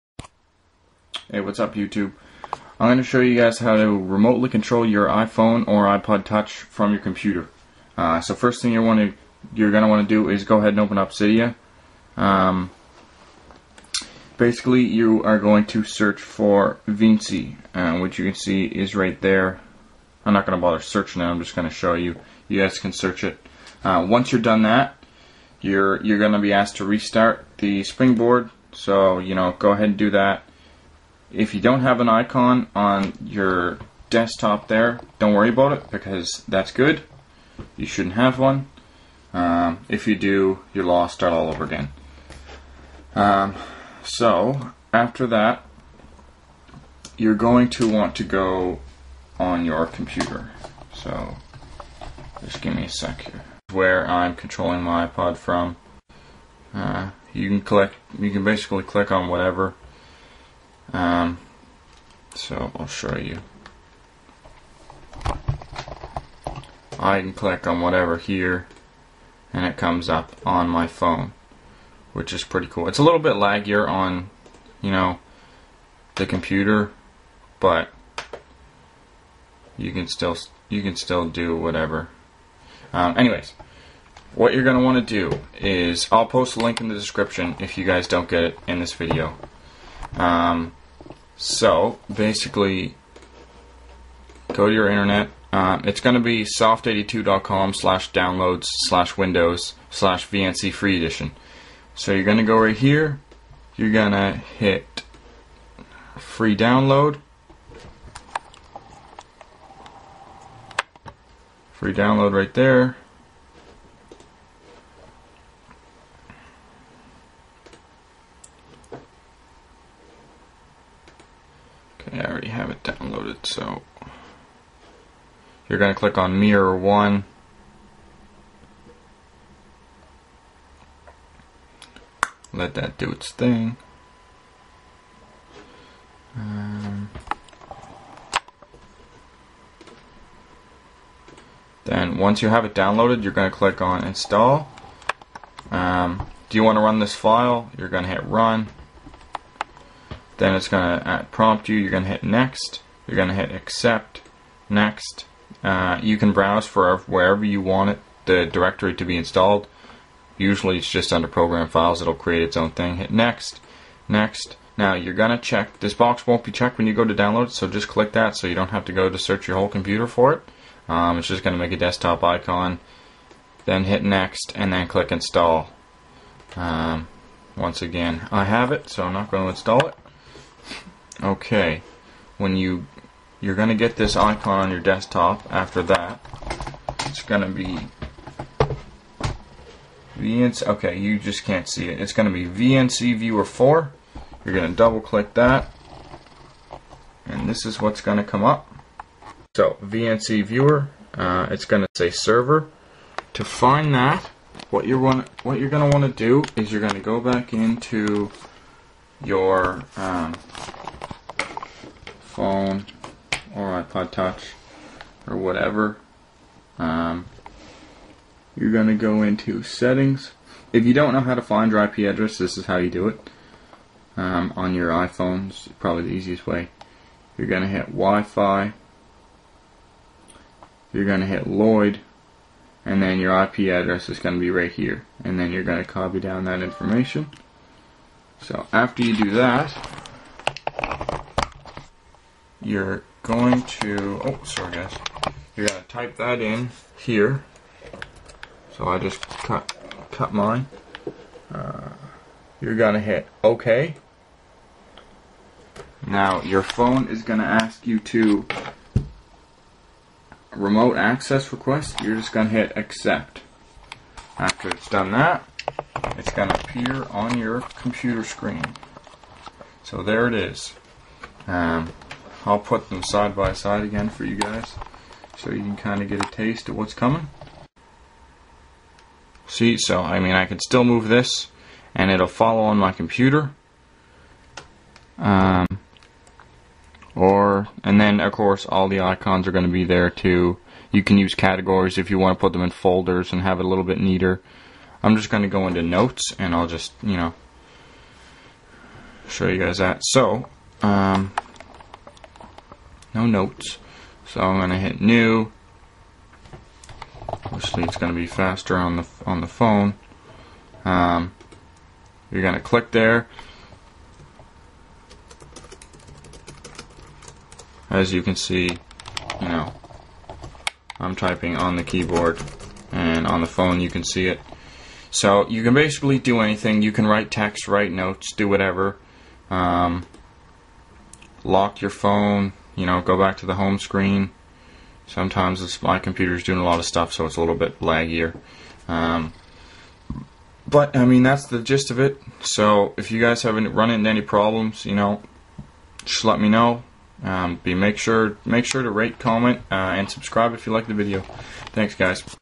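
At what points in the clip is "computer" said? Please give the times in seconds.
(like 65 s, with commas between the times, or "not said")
6 s, 49 s, 76 s, 169 s, 267 s, 282 s, 335 s.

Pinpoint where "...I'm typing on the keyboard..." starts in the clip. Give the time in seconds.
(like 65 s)
320 s.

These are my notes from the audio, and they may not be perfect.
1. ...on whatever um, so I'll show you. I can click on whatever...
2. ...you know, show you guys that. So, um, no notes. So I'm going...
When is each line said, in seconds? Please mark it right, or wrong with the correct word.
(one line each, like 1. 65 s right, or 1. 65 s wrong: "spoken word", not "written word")
1. 59 s right
2. 297 s right.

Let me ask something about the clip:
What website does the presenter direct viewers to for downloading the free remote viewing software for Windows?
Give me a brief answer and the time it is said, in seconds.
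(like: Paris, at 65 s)
soft82.com, at 96 s.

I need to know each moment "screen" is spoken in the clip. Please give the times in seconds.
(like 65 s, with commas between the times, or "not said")
268 s, 333 s.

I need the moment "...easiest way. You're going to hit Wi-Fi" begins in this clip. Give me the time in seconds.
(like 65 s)
226 s.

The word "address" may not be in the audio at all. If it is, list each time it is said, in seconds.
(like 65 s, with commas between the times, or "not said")
221 s, 233 s.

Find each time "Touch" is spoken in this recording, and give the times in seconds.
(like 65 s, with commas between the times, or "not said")
6 s, 214 s.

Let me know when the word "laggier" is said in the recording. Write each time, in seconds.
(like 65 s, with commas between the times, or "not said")
73 s, 337 s.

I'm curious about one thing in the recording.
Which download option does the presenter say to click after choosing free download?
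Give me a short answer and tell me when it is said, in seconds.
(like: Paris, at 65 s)
mirror 1, at 126 s.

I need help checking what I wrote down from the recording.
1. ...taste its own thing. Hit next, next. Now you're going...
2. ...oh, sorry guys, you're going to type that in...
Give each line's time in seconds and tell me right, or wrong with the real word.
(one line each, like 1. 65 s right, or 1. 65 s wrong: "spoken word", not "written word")
1. 162 s wrong: "create", not "taste"
2. 244 s right.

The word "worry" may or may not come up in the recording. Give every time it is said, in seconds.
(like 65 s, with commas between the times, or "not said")
35 s.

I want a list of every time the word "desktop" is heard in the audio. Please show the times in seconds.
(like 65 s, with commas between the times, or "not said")
34 s, 171 s, 184 s.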